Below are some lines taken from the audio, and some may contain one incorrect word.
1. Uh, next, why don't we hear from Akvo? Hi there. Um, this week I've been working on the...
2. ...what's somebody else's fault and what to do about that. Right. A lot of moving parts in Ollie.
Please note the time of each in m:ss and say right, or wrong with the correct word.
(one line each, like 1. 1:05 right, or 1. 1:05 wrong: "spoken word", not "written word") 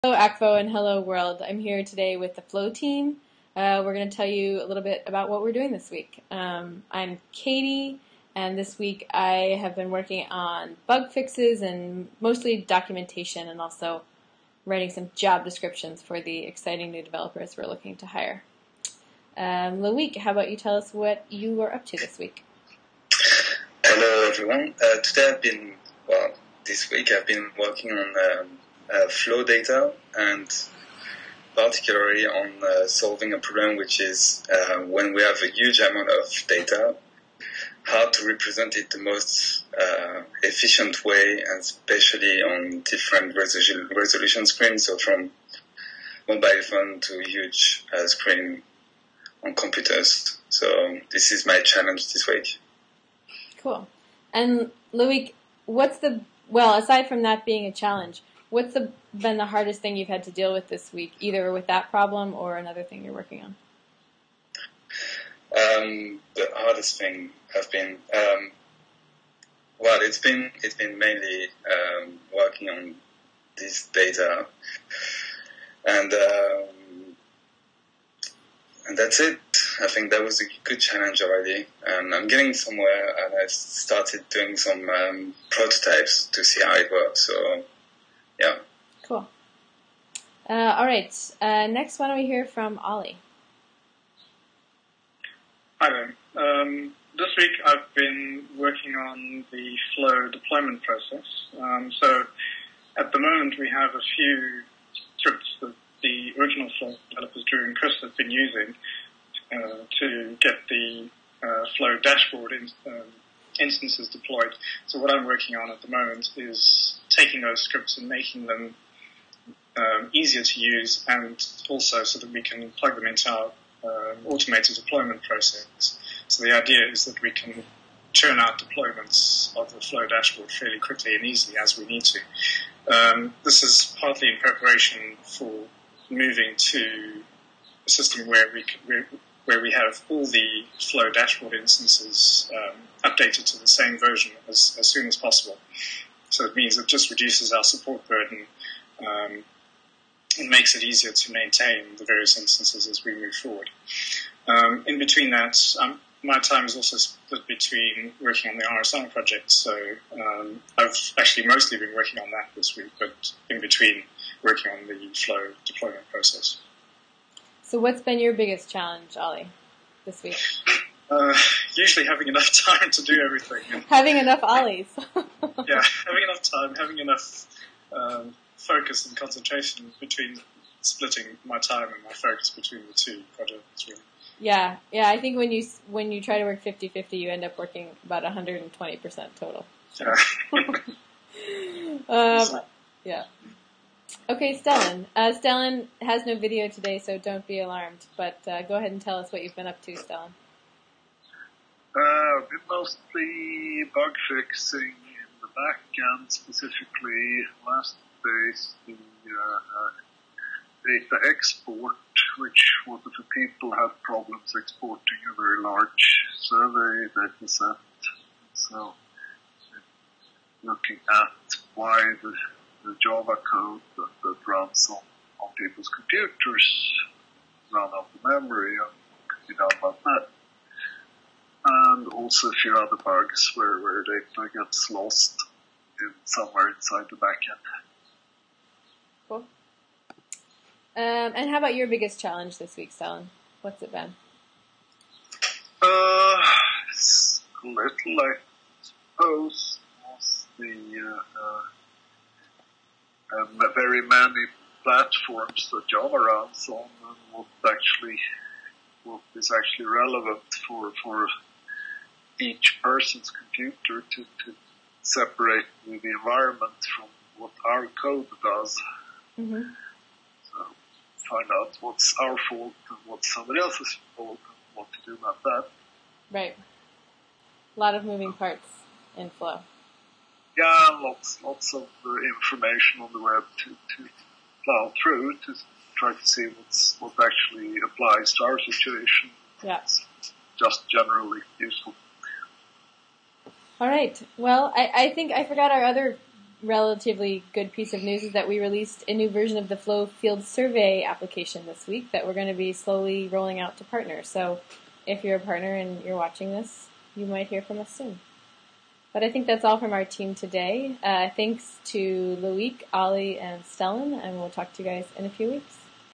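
1. 1:31 wrong: "Ollie", not "Akvo"
2. 4:33 wrong: "Flow", not "Ollie".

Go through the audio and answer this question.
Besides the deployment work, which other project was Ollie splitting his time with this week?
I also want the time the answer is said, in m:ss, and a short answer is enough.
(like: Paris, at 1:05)
RSR, at 2:38.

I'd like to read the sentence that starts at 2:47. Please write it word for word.
So what's been your biggest challenge, Ollie, this week?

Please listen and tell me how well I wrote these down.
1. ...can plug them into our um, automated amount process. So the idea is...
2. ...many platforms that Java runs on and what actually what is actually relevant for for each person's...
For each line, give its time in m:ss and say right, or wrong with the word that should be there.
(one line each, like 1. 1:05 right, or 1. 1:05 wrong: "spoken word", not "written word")
1. 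2:02 wrong: "deployment", not "amount"
2. 4:14 right.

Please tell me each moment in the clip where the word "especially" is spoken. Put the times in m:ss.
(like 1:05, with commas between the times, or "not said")
0:41.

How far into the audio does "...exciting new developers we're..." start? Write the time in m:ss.
0:16.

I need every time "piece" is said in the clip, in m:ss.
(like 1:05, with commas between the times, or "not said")
4:57.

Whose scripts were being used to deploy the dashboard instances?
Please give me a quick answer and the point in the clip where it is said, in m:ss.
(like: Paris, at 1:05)
Drew and Chris, at 1:47.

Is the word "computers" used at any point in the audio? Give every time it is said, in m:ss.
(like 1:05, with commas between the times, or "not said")
0:49, 3:45, 4:23.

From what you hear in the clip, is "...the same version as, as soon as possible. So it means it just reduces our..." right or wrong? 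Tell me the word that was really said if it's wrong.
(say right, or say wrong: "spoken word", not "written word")
right.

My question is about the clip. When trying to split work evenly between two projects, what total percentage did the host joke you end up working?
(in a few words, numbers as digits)
120%.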